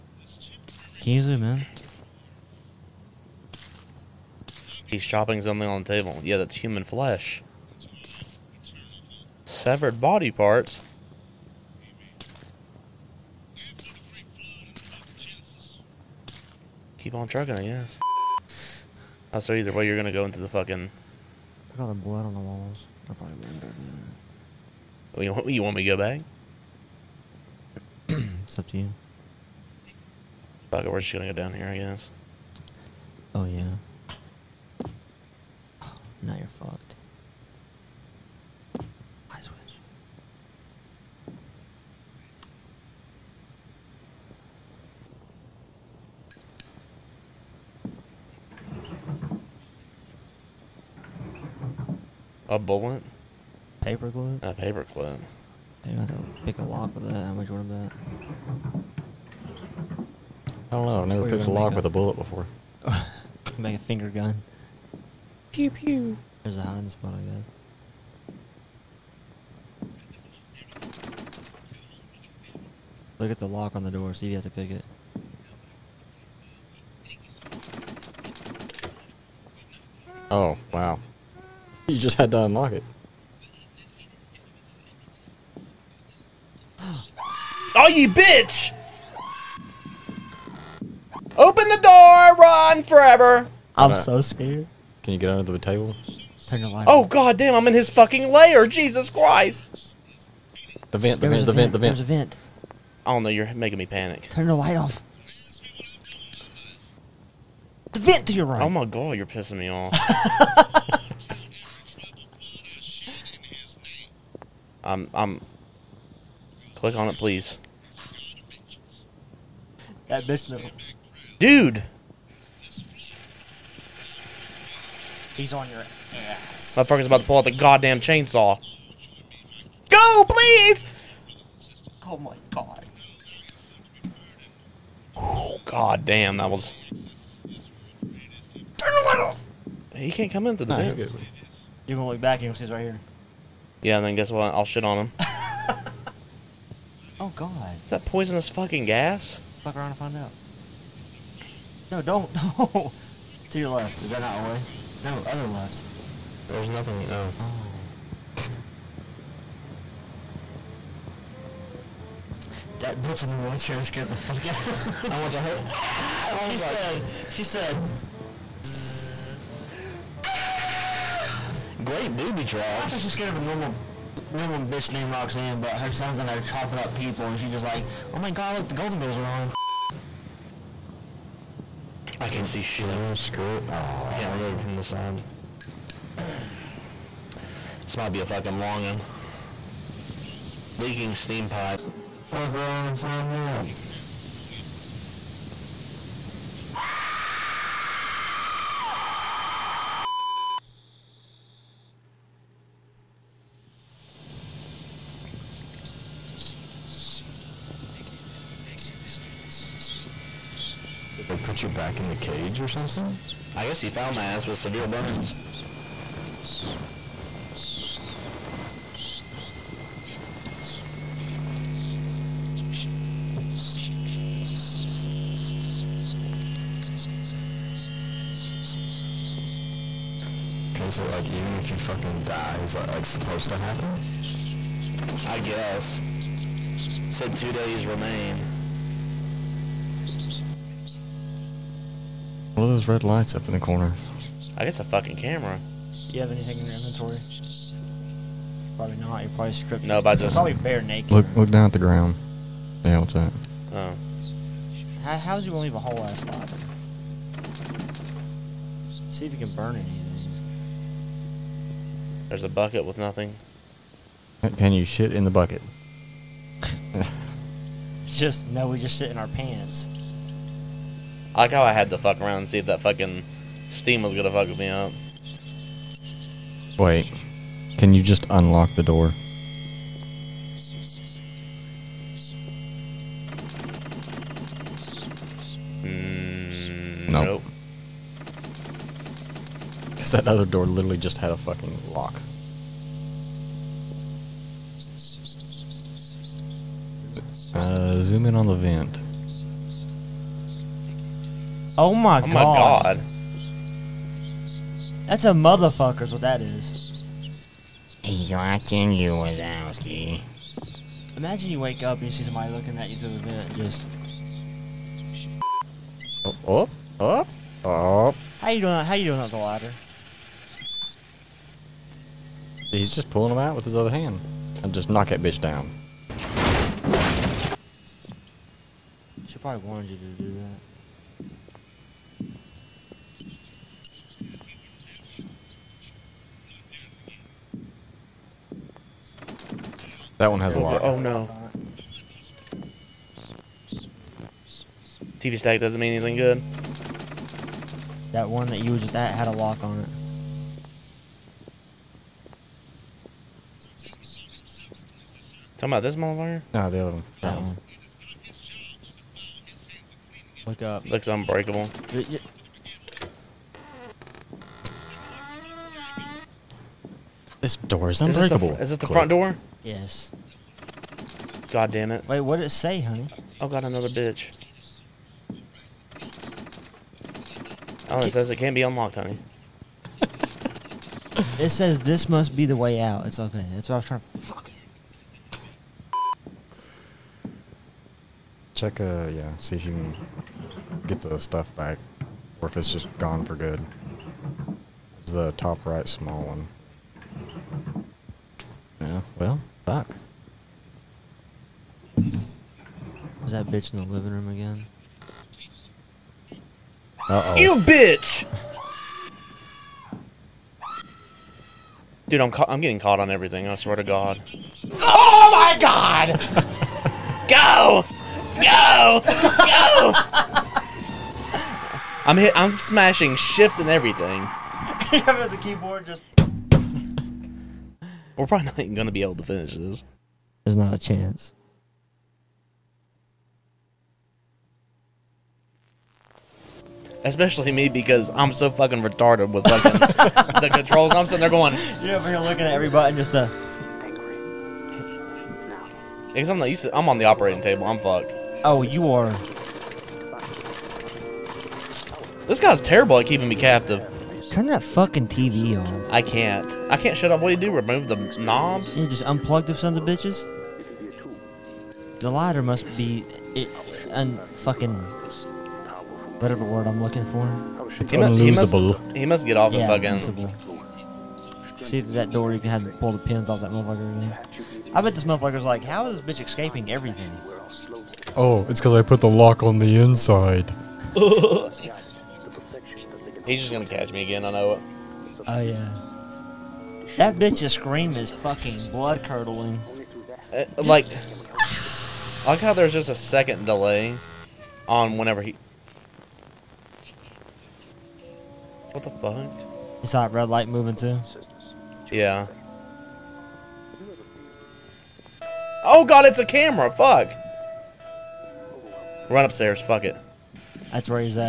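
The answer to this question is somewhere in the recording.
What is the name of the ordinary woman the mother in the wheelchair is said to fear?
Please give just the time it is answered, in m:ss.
2:55.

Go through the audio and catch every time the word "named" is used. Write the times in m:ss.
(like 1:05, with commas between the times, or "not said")
2:54.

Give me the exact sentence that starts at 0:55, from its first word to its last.
Maybe I pick a lock with that.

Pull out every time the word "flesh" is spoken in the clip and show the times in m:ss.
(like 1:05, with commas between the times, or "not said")
0:06.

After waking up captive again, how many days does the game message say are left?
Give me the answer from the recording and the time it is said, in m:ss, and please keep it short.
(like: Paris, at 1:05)
2, at 3:57.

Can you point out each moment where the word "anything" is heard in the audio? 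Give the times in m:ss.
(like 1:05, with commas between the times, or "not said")
4:06, 4:19, 5:45.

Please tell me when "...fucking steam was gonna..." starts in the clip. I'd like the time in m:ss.
4:32.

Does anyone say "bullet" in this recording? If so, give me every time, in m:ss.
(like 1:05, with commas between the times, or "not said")
0:52, 1:01.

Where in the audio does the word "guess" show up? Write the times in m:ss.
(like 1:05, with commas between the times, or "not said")
0:17, 0:31, 1:10, 2:24, 3:33, 3:55, 4:04.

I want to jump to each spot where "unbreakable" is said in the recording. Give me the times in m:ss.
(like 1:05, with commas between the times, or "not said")
6:01, 6:08.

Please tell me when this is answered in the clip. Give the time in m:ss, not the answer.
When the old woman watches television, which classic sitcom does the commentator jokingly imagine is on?
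2:58.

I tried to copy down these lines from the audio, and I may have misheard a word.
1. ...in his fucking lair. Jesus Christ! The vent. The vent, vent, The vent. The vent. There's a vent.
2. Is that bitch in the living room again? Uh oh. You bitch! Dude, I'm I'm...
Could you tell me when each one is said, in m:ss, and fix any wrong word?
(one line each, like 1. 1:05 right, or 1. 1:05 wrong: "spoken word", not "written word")
1. 1:37 right
2. 6:43 right.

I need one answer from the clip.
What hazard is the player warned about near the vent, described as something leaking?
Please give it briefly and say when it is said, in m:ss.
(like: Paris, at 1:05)
Steam pipe, at 3:10.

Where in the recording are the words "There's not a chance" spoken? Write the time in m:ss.
7:10.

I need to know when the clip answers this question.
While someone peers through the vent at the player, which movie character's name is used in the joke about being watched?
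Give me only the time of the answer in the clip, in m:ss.
5:09.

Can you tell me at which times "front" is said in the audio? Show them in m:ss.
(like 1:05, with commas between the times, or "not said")
6:08.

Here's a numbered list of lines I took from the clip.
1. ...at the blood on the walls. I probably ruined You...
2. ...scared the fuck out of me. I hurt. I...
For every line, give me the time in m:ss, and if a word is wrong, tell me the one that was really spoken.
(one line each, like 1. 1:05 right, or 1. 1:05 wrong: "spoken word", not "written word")
1. 0:21 right
2. 2:43 right.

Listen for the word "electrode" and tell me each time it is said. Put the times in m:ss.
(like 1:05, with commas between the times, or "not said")
not said.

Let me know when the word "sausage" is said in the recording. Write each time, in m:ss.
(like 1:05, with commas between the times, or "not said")
not said.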